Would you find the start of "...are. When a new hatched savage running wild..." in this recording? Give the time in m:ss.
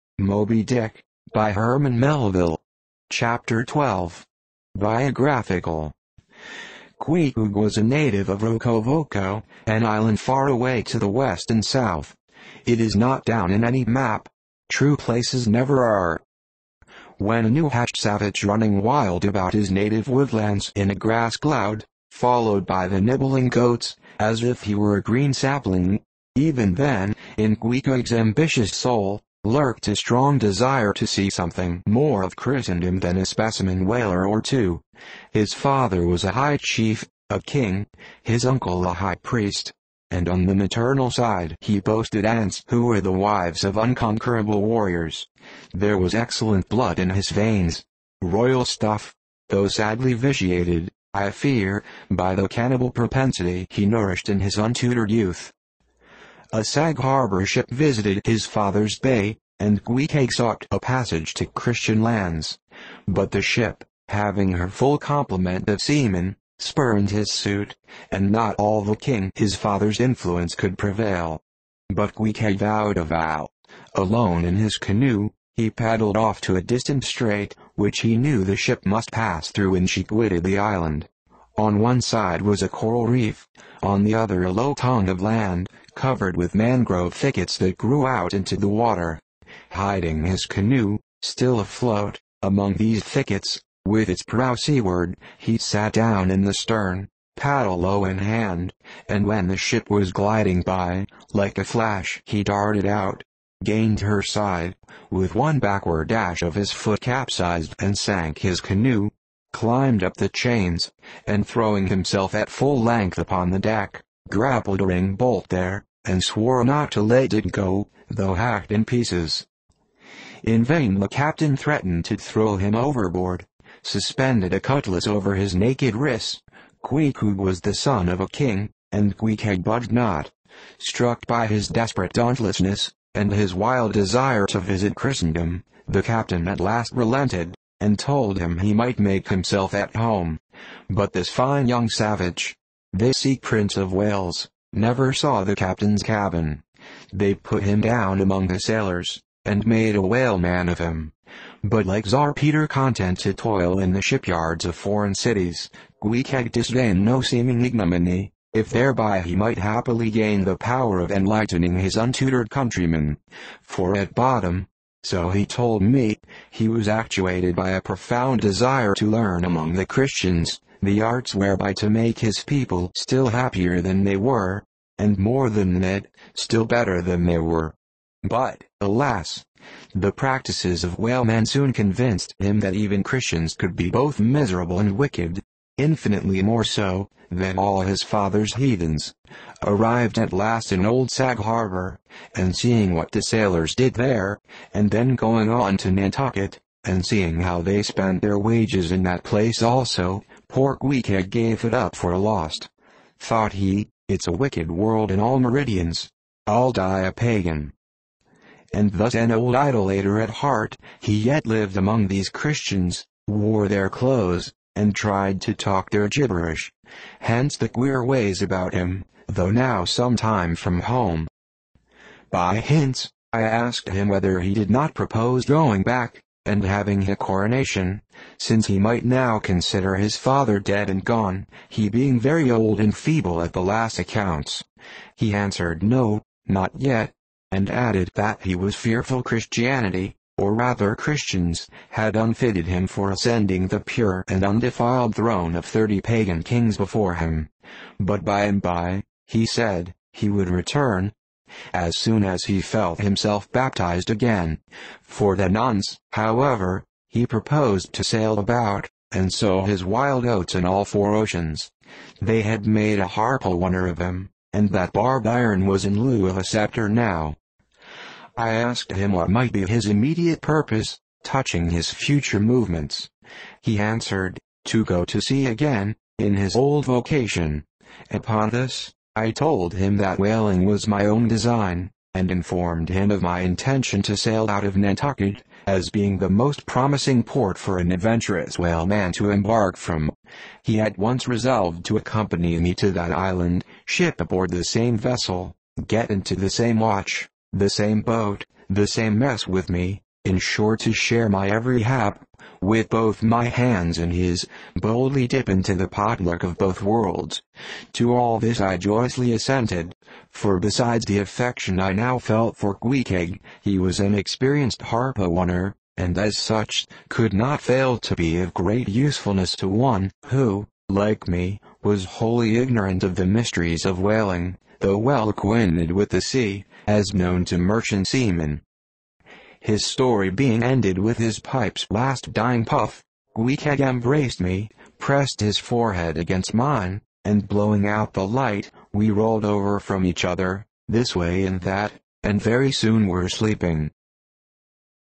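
0:15.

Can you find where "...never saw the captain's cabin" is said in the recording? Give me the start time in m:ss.
2:24.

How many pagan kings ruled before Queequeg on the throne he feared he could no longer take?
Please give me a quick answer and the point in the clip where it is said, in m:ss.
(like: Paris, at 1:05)
30, at 4:05.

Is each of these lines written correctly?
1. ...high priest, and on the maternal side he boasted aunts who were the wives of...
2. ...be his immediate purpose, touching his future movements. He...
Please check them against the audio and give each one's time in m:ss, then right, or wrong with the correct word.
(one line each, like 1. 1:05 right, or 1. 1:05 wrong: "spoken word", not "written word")
1. 0:38 right
2. 4:29 right.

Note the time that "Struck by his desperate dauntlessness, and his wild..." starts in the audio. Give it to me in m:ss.
2:10.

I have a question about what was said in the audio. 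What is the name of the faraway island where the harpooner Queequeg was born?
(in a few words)
Rokovoko.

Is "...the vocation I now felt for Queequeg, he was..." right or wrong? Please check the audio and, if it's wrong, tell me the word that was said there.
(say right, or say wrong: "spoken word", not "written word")
wrong: "affection", not "vocation".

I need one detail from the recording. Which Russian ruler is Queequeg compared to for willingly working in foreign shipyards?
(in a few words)
Tsar Peter.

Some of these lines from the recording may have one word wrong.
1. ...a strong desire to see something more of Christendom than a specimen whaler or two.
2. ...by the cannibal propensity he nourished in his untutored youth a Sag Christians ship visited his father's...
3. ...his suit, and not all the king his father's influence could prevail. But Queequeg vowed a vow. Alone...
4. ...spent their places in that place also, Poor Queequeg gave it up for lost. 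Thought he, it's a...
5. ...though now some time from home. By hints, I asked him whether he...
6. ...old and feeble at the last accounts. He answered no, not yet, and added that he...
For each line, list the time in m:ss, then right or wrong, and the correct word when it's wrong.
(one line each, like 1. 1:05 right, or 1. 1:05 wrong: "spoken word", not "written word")
1. 0:29 right
2. 0:52 wrong: "Harbor", not "Christians"
3. 1:07 right
4. 3:17 wrong: "wages", not "places"
5. 3:39 right
6. 3:52 right.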